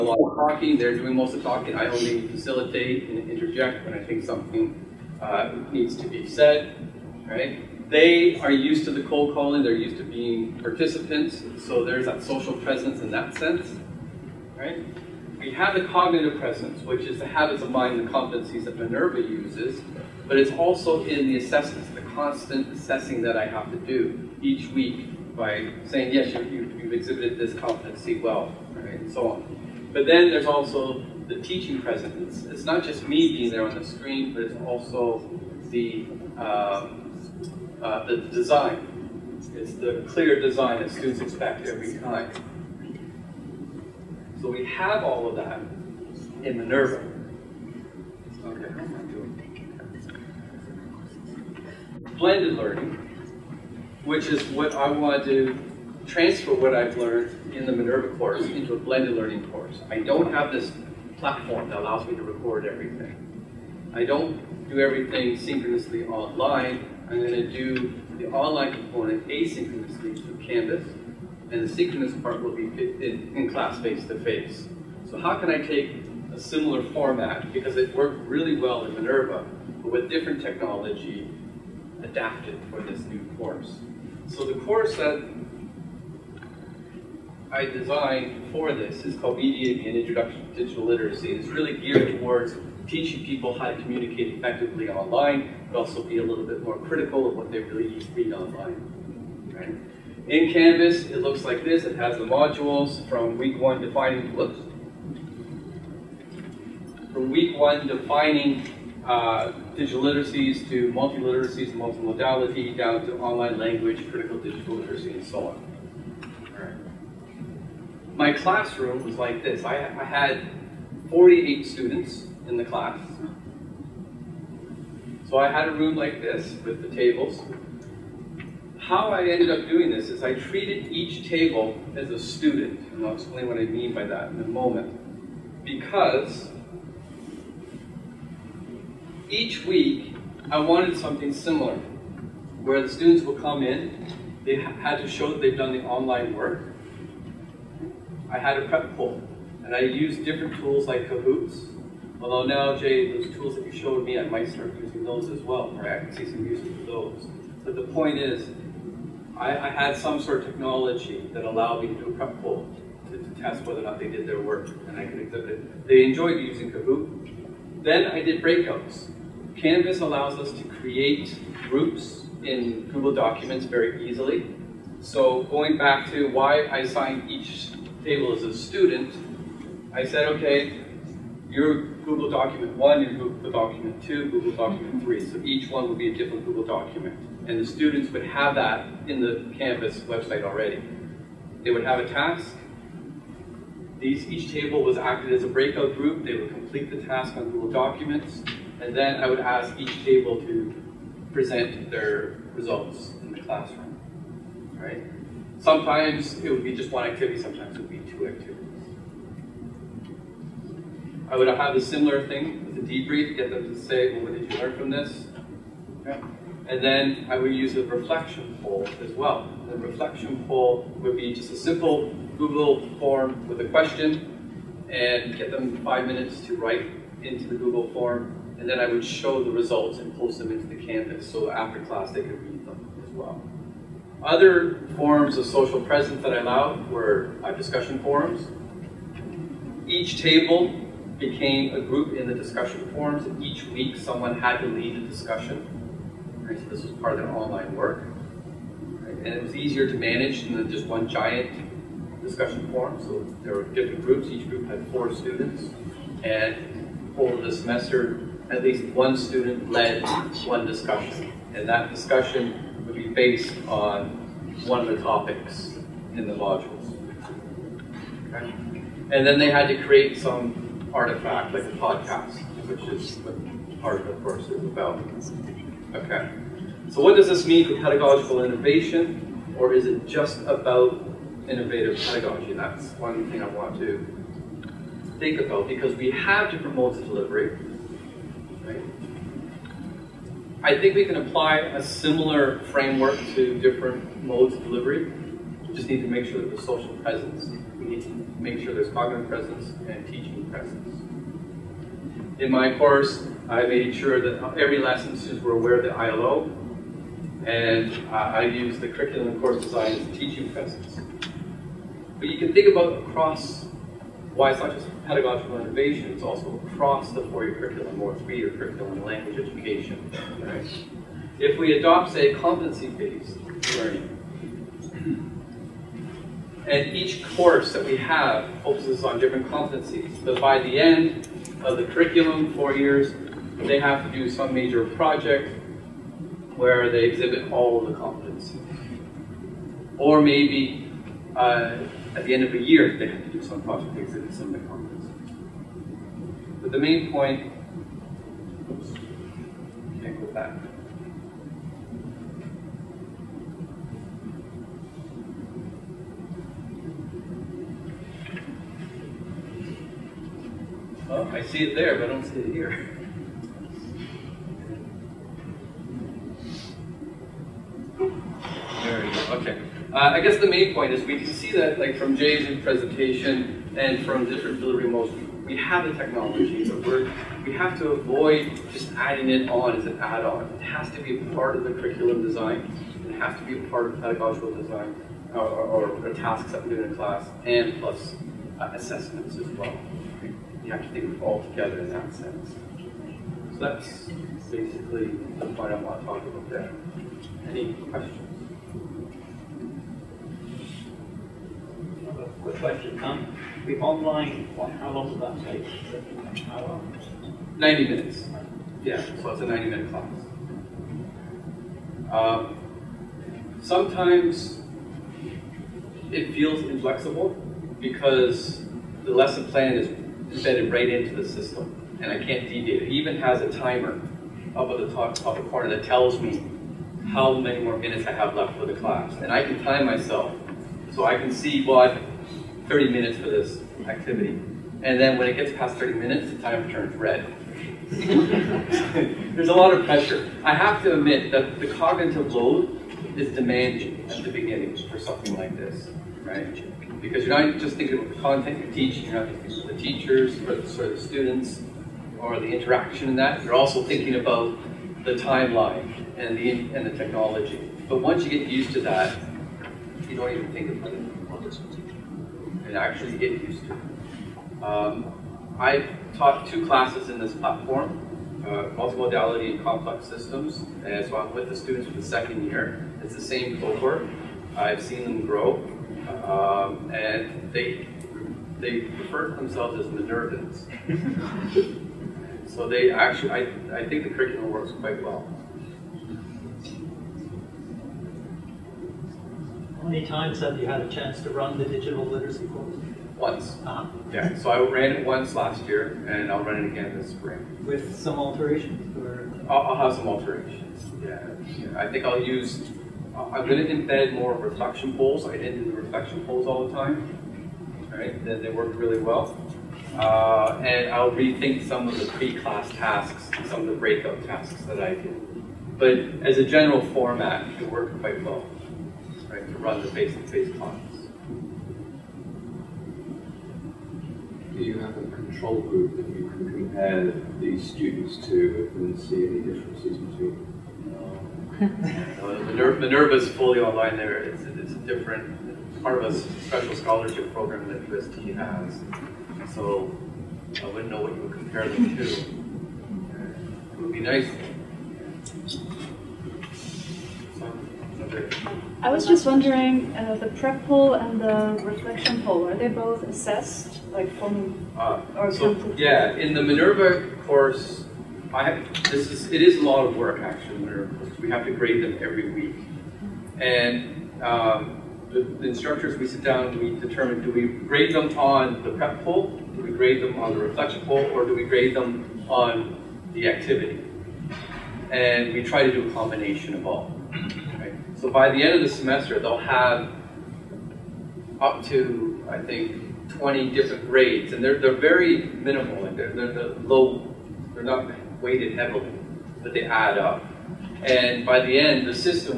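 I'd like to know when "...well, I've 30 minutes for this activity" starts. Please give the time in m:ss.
7:11.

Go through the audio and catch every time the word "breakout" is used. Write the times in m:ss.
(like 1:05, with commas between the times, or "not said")
2:48, 3:15, 8:33.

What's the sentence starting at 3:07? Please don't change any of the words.
And the students would have that in the Canvas website already.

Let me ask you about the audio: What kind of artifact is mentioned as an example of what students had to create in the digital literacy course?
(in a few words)
a podcast.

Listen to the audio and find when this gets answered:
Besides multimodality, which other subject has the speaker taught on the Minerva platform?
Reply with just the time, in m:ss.
7:49.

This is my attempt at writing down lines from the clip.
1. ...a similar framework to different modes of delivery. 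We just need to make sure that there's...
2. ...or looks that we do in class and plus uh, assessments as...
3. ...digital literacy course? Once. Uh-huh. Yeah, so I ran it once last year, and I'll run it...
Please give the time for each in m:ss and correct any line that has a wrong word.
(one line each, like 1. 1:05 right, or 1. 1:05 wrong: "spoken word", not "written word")
1. 4:51 right
2. 6:26 wrong: "tasks", not "looks"
3. 8:11 right.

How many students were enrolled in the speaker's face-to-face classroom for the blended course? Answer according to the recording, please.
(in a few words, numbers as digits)
48.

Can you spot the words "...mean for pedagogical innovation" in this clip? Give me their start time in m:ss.
4:37.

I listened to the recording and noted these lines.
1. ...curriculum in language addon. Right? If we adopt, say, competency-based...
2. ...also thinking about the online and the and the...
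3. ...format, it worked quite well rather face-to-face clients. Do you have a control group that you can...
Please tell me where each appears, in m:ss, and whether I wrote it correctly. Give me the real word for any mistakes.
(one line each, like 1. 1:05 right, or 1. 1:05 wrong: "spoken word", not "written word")
1. 5:18 wrong: "education", not "addon"
2. 7:33 wrong: "timeline", not "online"
3. 8:36 right.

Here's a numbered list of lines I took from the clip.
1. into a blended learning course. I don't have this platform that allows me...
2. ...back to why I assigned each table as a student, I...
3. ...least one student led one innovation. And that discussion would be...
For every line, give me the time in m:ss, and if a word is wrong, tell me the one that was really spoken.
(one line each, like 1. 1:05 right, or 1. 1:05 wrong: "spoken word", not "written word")
1. 0:58 right
2. 2:55 right
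3. 4:18 wrong: "discussion", not "innovation".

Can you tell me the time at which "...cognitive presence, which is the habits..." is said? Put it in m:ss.
0:15.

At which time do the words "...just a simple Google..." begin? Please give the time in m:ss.
3:41.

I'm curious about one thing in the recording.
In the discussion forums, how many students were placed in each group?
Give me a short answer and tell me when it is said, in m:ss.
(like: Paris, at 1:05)
4, at 4:14.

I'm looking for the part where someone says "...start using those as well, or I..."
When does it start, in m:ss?
2:34.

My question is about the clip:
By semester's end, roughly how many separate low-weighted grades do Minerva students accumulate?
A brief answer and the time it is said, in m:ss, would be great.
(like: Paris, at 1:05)
20, at 9:43.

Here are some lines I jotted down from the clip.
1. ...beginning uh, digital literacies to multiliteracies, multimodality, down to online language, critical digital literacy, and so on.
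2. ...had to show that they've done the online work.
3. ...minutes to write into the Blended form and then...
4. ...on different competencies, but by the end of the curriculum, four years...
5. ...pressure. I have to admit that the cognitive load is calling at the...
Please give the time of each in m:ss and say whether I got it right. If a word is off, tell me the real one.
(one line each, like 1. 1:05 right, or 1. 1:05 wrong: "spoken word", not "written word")
1. 1:47 wrong: "defining", not "beginning"
2. 2:24 right
3. 3:46 wrong: "Google", not "Blended"
4. 5:29 right
5. 7:19 wrong: "demanding", not "calling".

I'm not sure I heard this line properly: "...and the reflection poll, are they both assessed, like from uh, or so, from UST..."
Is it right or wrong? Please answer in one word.
wrong.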